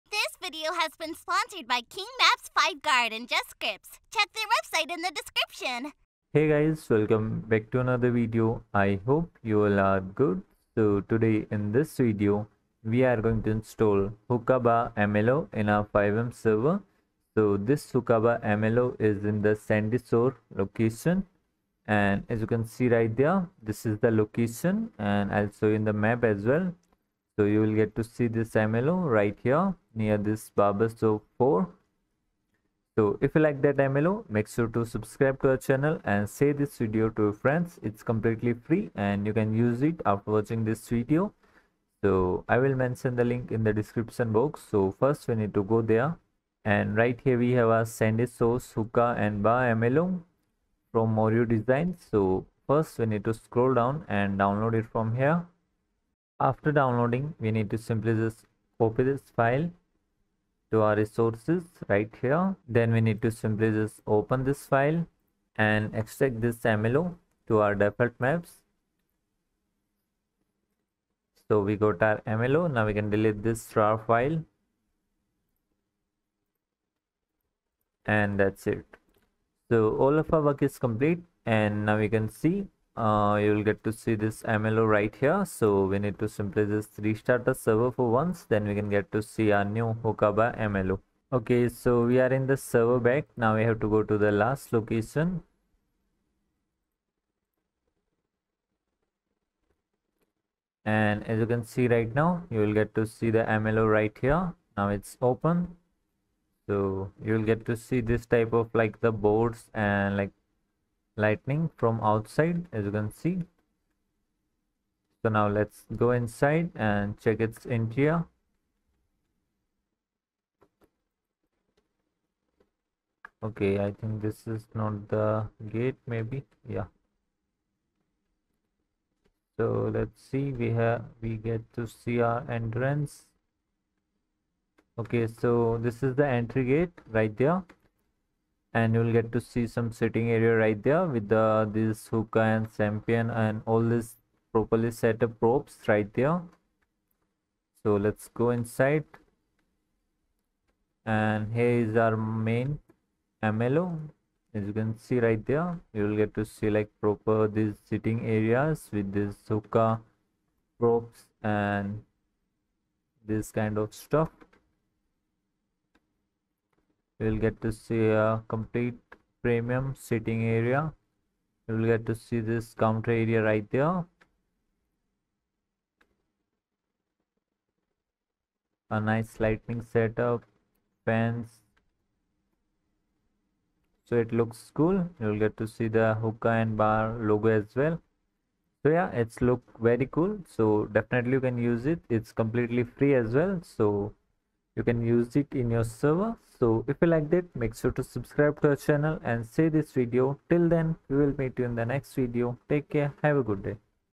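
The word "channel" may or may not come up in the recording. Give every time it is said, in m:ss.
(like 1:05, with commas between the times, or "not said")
0:35, 3:18.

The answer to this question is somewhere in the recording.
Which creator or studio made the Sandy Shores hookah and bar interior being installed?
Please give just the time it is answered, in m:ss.
0:51.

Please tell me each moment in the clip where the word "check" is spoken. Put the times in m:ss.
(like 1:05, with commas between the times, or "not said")
0:04, 1:57.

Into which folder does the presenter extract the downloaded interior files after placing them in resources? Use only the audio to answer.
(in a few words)
default maps.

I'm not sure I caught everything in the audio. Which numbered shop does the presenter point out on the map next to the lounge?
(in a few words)
barbershop 4.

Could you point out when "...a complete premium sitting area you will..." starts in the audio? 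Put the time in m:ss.
2:48.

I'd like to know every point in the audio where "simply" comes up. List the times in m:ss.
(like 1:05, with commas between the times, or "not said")
0:57, 1:03, 1:26.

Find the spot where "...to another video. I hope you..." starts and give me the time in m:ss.
0:07.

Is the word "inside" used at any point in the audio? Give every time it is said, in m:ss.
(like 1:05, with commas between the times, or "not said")
1:56, 2:28.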